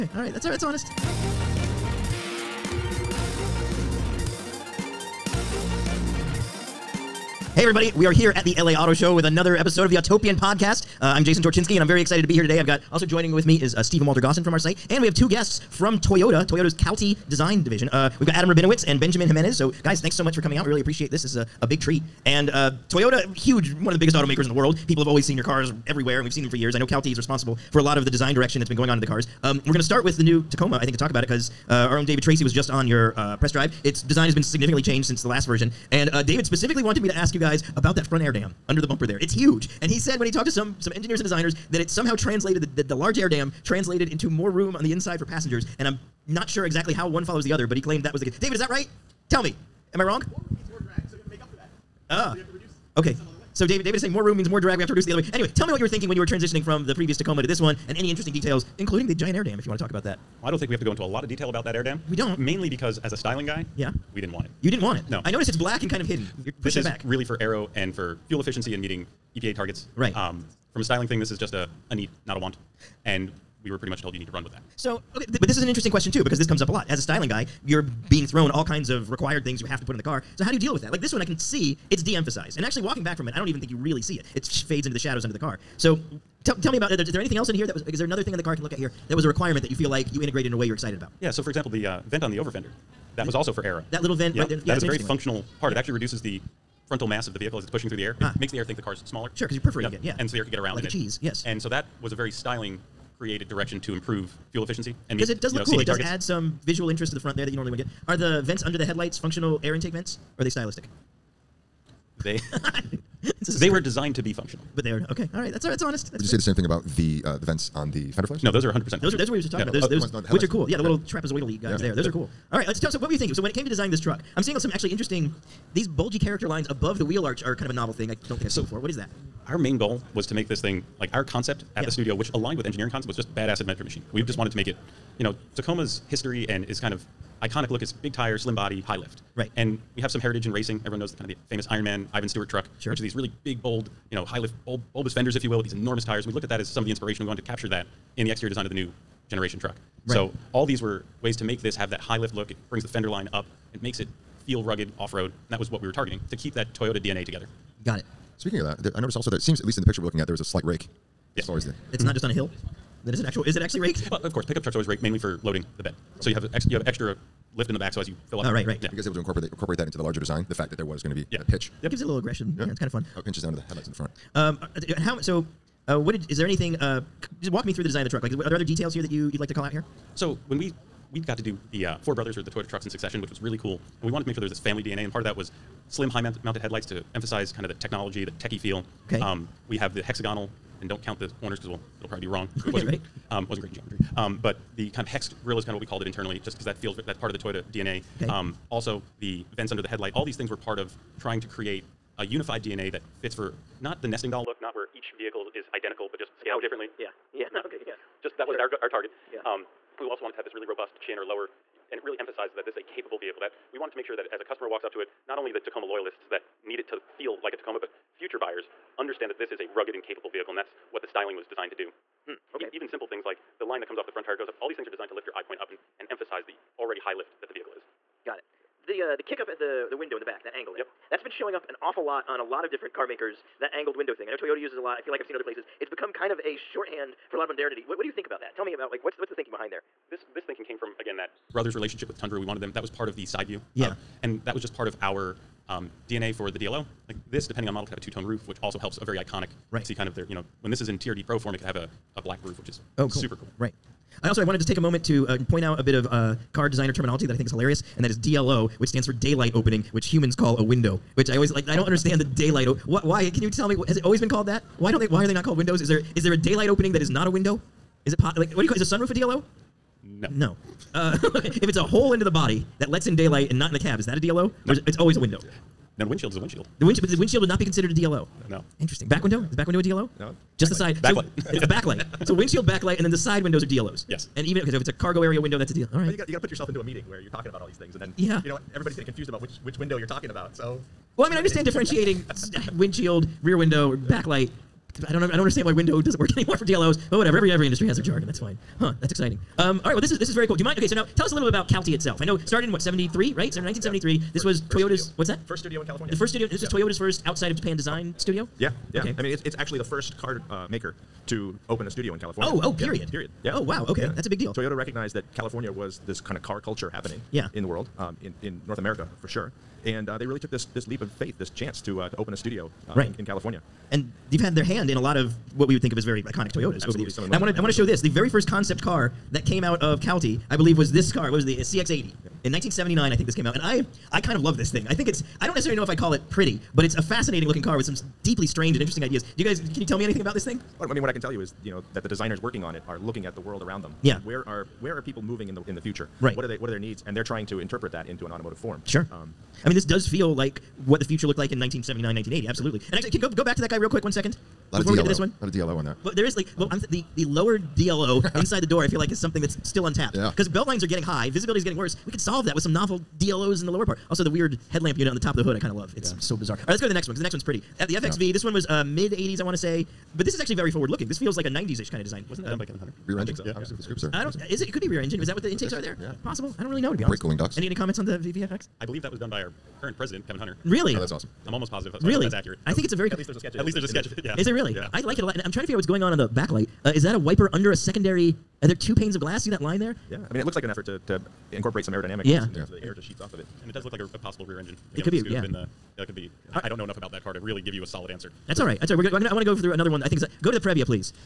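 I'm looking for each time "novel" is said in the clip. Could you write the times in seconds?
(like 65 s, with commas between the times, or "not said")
127 s, 362 s.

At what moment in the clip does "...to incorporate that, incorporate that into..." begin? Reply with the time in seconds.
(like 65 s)
169 s.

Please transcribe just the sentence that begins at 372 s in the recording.
Wasn't that um, done by Kevin Hunter?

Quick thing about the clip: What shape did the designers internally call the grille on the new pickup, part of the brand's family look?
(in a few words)
hex grill.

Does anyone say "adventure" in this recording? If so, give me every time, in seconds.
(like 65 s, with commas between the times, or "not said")
133 s.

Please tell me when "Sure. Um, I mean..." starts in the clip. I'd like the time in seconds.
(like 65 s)
348 s.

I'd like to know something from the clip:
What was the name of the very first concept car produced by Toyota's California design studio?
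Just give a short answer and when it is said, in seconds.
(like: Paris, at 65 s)
CX80, at 331 s.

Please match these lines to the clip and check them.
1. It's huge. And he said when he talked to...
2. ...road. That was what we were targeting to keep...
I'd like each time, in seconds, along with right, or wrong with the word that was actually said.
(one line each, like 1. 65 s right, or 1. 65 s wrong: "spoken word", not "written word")
1. 39 s right
2. 155 s right.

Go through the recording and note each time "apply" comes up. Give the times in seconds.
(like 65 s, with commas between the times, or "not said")
not said.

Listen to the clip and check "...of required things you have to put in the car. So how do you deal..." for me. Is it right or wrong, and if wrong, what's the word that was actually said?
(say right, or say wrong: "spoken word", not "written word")
right.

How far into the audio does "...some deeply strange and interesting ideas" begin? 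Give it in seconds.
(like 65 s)
337 s.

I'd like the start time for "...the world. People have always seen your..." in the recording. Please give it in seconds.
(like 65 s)
24 s.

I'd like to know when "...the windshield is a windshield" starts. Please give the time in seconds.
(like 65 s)
276 s.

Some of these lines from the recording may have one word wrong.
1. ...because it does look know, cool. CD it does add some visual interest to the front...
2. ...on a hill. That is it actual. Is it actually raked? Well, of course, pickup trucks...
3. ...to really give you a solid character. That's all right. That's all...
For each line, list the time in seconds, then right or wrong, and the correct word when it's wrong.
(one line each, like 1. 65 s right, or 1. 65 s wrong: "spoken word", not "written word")
1. 105 s right
2. 162 s right
3. 397 s wrong: "answer", not "character".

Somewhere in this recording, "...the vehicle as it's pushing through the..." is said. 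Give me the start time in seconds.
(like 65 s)
97 s.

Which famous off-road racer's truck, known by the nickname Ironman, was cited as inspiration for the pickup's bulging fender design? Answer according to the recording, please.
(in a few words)
Ivan Stewart.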